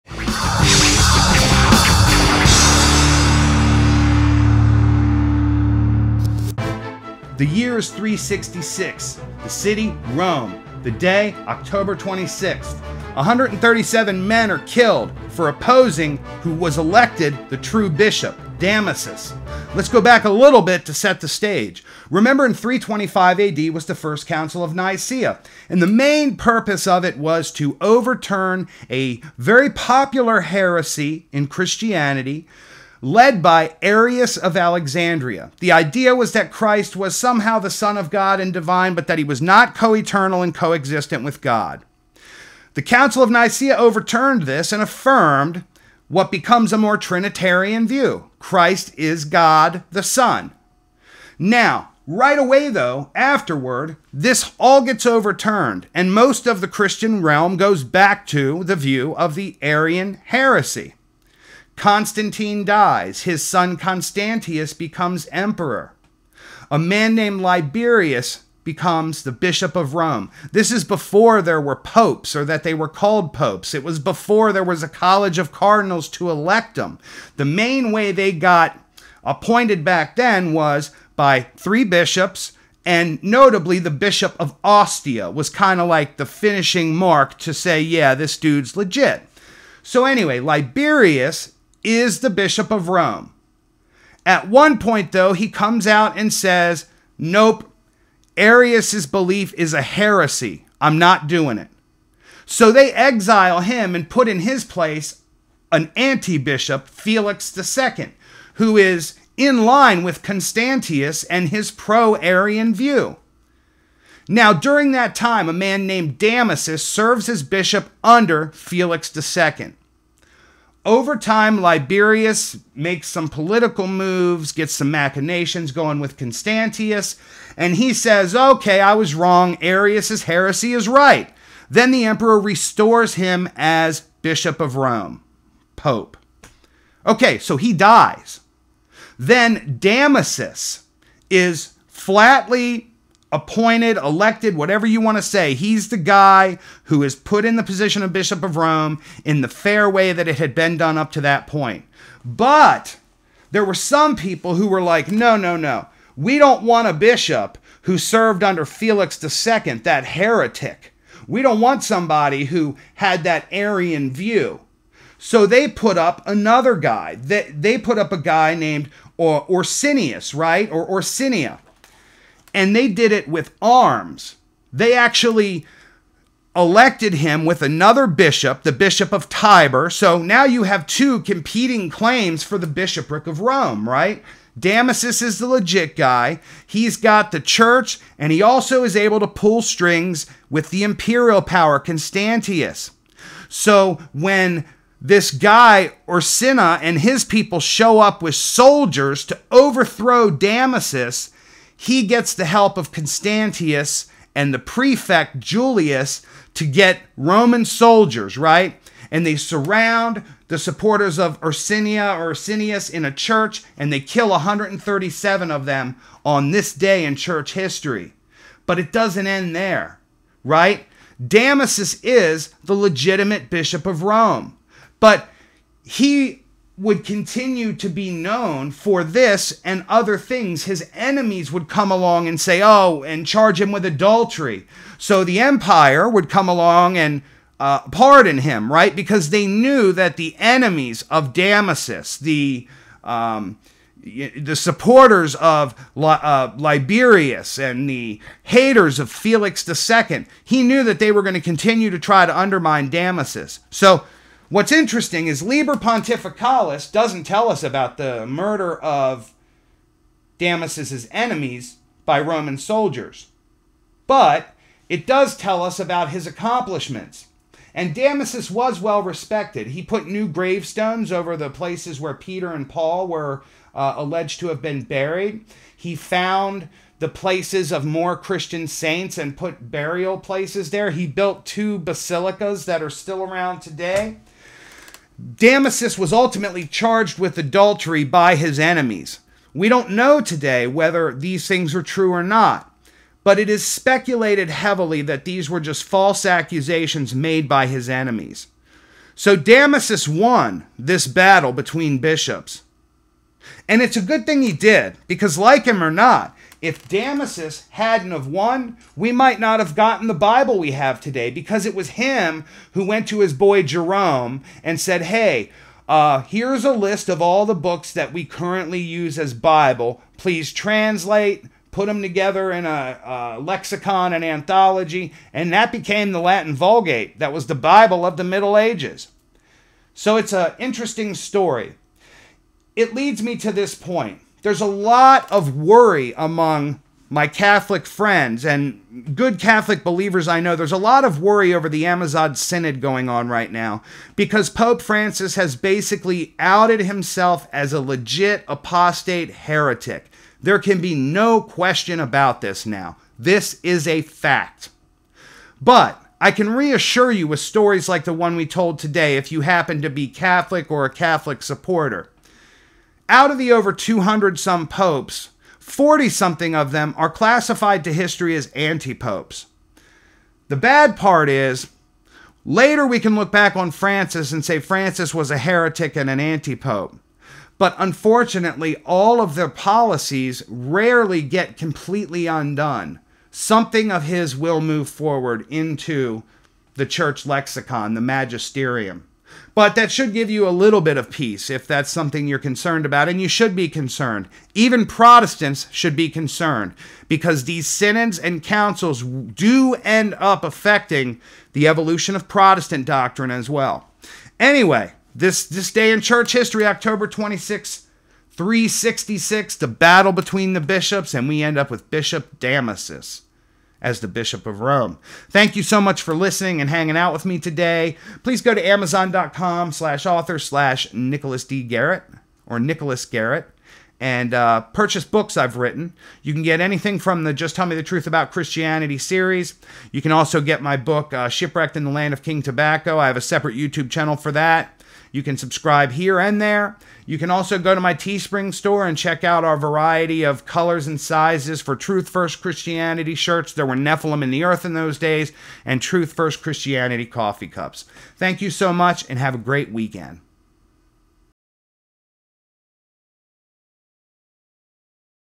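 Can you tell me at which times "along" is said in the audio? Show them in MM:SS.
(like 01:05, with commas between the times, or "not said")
03:51, 03:56.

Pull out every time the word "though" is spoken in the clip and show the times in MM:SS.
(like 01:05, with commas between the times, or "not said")
00:52, 01:35.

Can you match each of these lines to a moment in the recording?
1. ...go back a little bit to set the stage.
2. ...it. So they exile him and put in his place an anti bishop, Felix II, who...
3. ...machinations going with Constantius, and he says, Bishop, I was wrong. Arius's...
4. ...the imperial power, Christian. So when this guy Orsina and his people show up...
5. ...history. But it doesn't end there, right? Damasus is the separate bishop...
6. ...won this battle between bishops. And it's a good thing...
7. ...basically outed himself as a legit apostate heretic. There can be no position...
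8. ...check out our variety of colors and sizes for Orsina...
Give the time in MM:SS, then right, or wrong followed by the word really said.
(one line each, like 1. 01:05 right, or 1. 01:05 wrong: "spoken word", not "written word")
1. 00:19 right
2. 01:41 right
3. 02:04 wrong: "Okay", not "Bishop"
4. 03:10 wrong: "Constantius", not "Christian"
5. 03:37 wrong: "legitimate", not "separate"
6. 05:00 right
7. 05:45 wrong: "question", not "position"
8. 07:18 wrong: "Truth", not "Orsina".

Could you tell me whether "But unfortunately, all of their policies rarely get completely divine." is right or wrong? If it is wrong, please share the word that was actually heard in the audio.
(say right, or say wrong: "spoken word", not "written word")
wrong: "undone", not "divine".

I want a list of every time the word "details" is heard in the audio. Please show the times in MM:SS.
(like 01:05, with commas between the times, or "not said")
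not said.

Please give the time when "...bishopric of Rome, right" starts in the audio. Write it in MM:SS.
03:02.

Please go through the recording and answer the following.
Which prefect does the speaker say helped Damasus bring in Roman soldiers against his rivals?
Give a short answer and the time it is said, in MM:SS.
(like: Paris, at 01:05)
Julius, at 03:25.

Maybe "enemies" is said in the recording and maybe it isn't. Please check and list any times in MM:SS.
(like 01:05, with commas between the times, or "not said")
03:50, 04:00, 04:21, 04:48, 04:57.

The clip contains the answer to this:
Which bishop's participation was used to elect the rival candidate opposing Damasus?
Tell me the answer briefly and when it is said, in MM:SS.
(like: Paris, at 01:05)
Bishop of Tibur, at 02:58.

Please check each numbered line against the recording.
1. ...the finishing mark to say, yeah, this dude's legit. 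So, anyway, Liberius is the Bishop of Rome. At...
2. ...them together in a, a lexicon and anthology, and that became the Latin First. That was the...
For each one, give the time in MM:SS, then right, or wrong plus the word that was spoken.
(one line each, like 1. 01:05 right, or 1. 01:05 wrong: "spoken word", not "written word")
1. 01:26 right
2. 05:21 wrong: "Vulgate", not "First".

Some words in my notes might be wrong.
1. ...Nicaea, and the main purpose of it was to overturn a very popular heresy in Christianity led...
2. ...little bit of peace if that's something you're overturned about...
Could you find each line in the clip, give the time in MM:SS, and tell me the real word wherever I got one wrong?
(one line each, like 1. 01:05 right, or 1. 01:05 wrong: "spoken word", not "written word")
1. 00:24 right
2. 06:30 wrong: "concerned", not "overturned".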